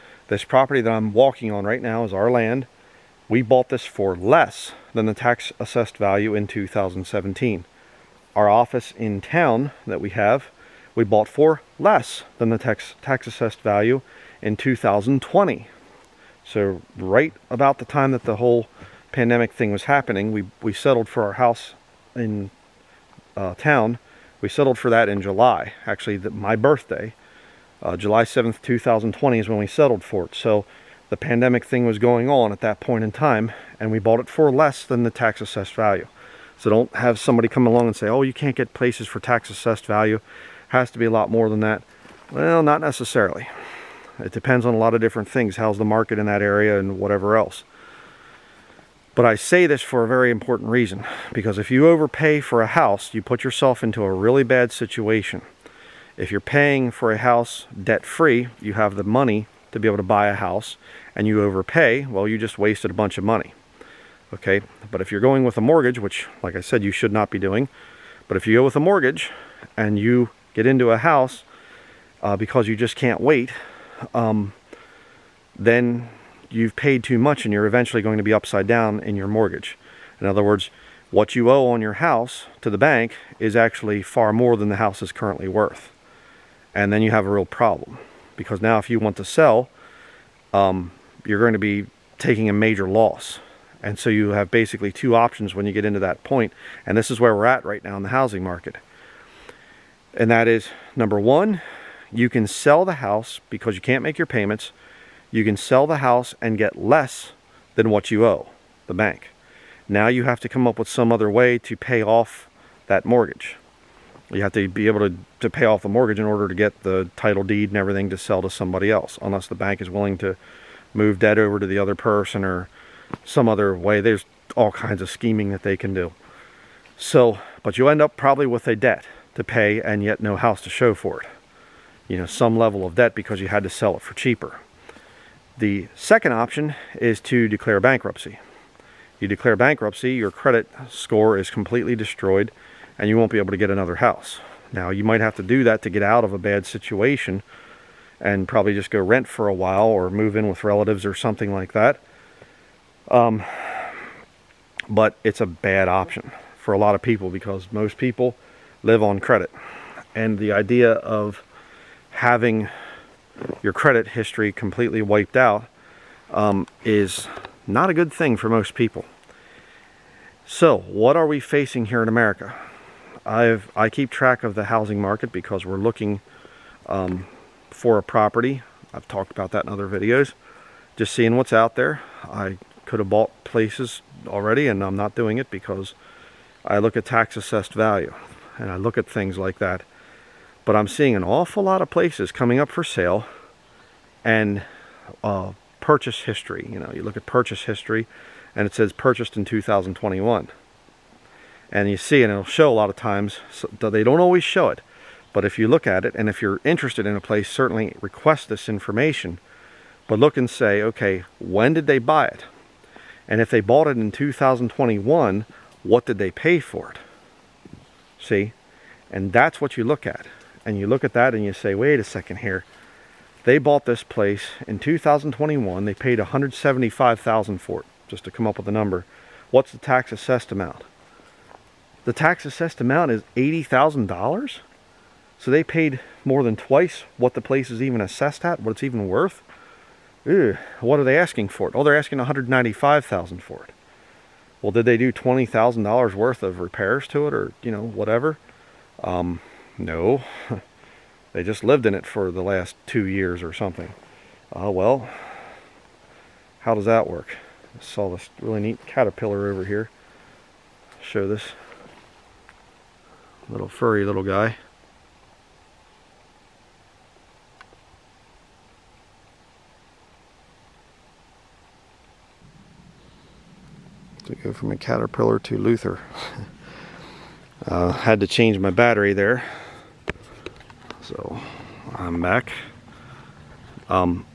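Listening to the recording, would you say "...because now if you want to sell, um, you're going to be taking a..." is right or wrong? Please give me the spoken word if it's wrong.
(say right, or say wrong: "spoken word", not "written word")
right.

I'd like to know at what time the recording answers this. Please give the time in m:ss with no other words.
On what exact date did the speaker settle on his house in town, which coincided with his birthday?
0:27.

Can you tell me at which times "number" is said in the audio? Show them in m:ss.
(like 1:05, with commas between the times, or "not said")
1:40, 3:48.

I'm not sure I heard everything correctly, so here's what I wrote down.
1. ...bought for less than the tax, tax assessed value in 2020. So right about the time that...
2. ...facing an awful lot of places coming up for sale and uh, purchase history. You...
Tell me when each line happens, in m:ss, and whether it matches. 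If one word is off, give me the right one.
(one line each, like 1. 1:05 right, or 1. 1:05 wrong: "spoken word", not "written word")
1. 0:11 right
2. 3:10 wrong: "seeing", not "facing".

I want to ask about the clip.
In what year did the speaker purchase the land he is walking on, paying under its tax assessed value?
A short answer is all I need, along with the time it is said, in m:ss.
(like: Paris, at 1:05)
2017, at 0:06.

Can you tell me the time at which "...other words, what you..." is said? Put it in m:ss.
1:20.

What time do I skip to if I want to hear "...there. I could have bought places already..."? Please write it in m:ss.
3:01.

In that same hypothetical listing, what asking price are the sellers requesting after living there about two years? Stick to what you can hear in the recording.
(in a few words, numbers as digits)
195,000.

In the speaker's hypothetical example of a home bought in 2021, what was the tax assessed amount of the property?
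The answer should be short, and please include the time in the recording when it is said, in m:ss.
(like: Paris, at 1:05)
$80,000, at 3:53.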